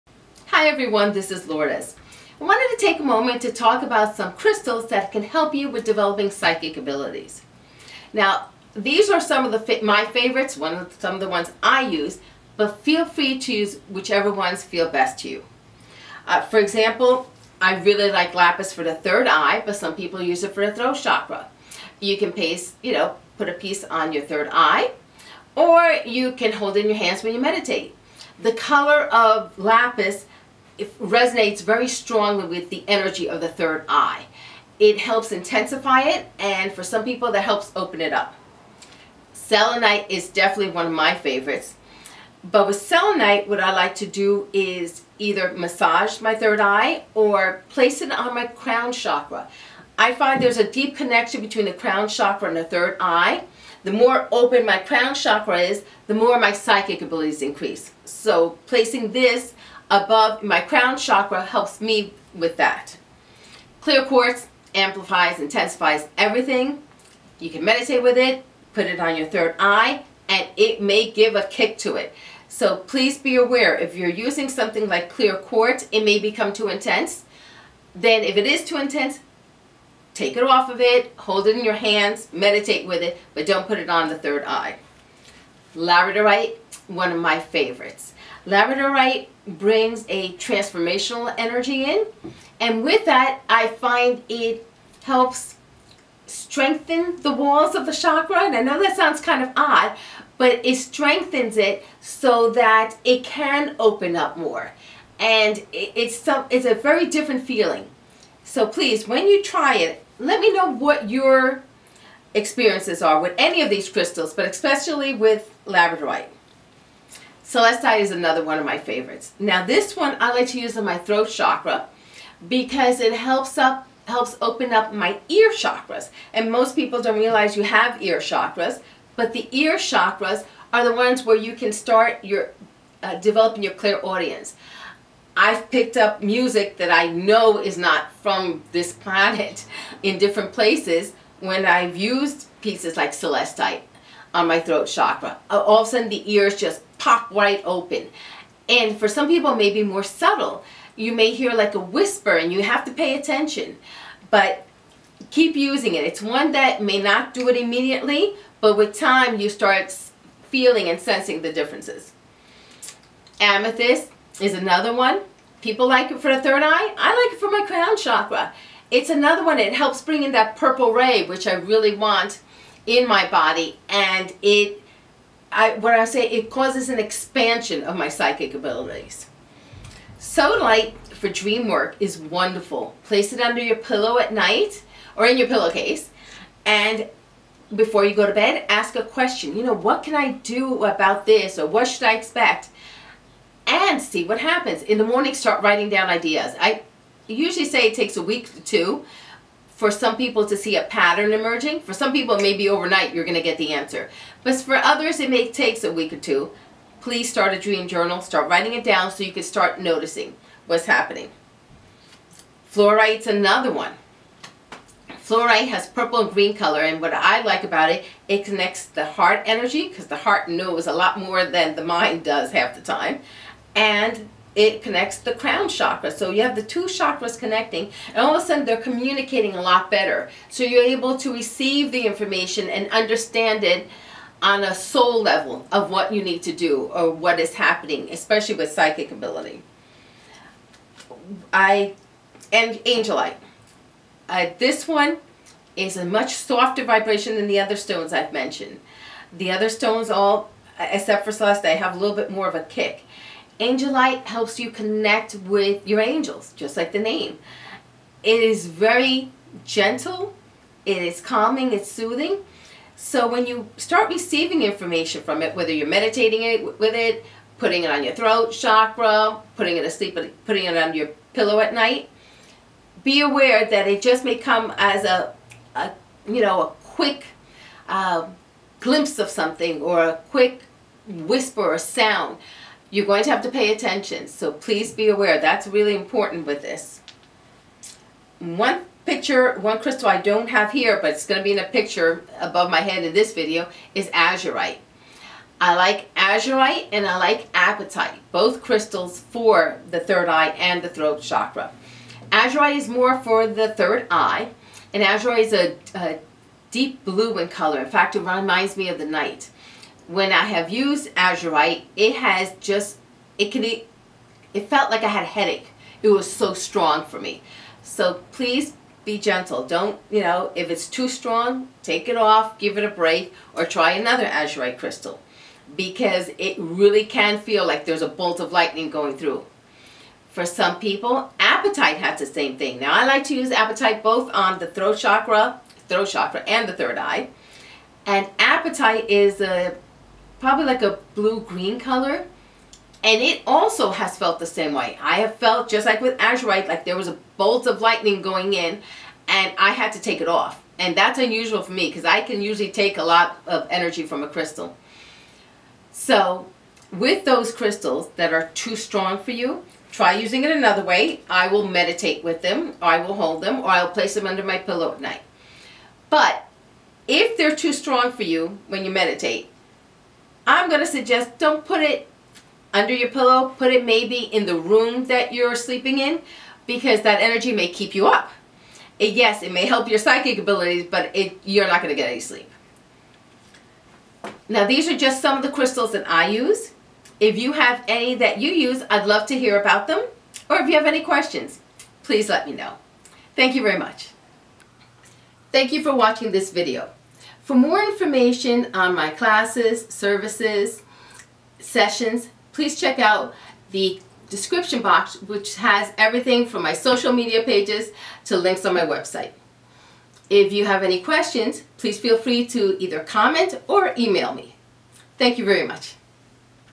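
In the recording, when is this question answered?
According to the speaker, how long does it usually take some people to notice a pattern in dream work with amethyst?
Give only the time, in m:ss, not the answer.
3:18.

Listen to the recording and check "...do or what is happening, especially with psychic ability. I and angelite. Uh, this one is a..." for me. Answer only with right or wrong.
right.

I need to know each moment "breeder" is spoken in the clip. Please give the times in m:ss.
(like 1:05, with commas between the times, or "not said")
not said.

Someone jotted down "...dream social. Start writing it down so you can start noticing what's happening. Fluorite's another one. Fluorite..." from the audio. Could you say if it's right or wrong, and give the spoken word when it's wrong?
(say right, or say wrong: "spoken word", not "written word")
wrong: "journal", not "social".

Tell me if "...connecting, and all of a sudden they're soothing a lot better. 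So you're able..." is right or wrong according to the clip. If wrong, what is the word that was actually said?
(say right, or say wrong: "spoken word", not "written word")
wrong: "communicating", not "soothing".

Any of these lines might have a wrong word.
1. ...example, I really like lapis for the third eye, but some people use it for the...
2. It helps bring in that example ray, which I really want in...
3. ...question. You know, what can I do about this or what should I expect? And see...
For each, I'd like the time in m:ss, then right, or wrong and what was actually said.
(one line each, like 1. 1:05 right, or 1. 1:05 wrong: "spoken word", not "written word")
1. 0:16 right
2. 2:49 wrong: "purple", not "example"
3. 3:09 right.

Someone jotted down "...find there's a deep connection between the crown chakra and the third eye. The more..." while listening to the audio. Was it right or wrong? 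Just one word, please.
right.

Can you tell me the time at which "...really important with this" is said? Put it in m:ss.
4:45.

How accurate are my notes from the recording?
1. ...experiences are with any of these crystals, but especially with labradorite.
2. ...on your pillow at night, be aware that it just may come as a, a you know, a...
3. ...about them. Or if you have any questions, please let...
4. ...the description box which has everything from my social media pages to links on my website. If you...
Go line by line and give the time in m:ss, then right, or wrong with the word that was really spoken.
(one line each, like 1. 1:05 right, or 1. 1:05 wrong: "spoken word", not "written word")
1. 1:52 right
2. 4:30 right
3. 6:29 right
4. 6:43 right.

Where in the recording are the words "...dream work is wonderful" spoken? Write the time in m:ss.
3:01.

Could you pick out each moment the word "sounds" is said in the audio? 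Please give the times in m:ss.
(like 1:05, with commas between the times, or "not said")
1:38, 4:41.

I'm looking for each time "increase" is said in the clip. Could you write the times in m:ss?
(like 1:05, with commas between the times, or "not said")
0:57.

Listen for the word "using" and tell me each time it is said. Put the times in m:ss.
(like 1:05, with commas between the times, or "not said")
1:14, 2:35, 6:00.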